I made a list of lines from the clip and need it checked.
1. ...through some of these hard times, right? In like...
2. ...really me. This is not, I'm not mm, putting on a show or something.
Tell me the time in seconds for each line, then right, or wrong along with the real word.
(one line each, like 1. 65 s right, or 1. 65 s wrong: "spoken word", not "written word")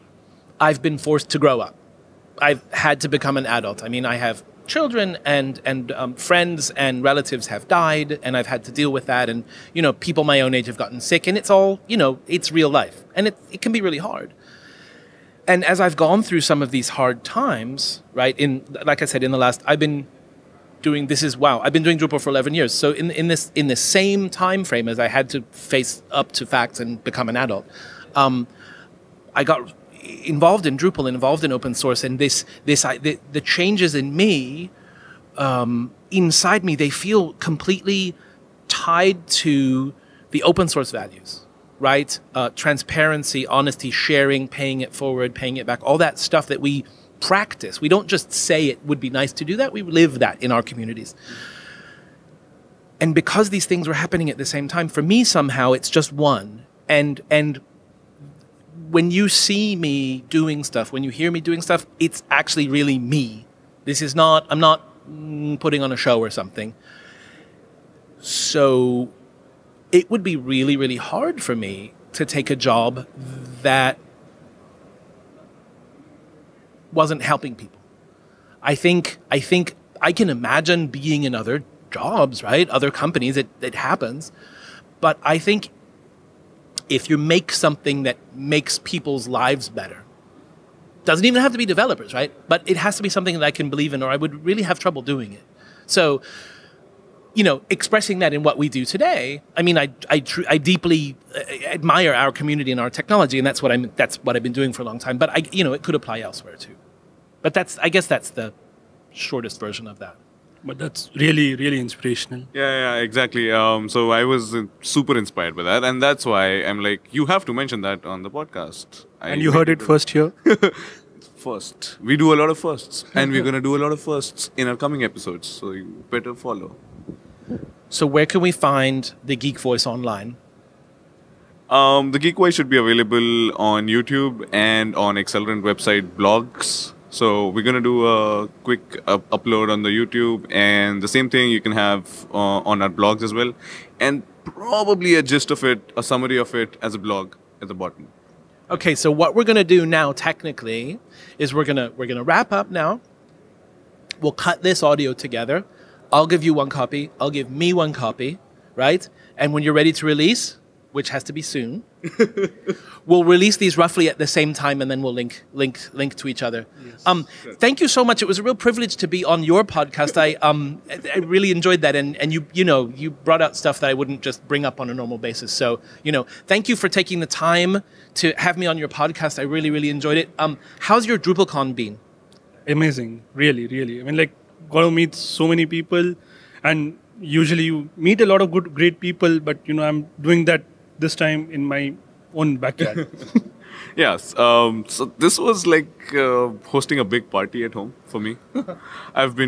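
1. 16 s right
2. 62 s right.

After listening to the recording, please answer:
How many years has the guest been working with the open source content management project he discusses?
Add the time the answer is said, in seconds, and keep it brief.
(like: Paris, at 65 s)
11, at 22 s.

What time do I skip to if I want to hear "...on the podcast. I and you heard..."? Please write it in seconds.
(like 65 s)
118 s.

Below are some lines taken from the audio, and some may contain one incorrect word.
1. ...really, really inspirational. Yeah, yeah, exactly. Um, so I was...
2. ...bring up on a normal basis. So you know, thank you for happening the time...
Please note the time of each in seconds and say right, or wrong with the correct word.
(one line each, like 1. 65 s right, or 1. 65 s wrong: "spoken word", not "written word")
1. 111 s right
2. 174 s wrong: "taking", not "happening".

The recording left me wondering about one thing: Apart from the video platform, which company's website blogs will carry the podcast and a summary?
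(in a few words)
Axelerant.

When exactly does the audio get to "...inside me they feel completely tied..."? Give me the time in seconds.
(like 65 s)
36 s.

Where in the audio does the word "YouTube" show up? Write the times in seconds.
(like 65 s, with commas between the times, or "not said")
133 s, 139 s.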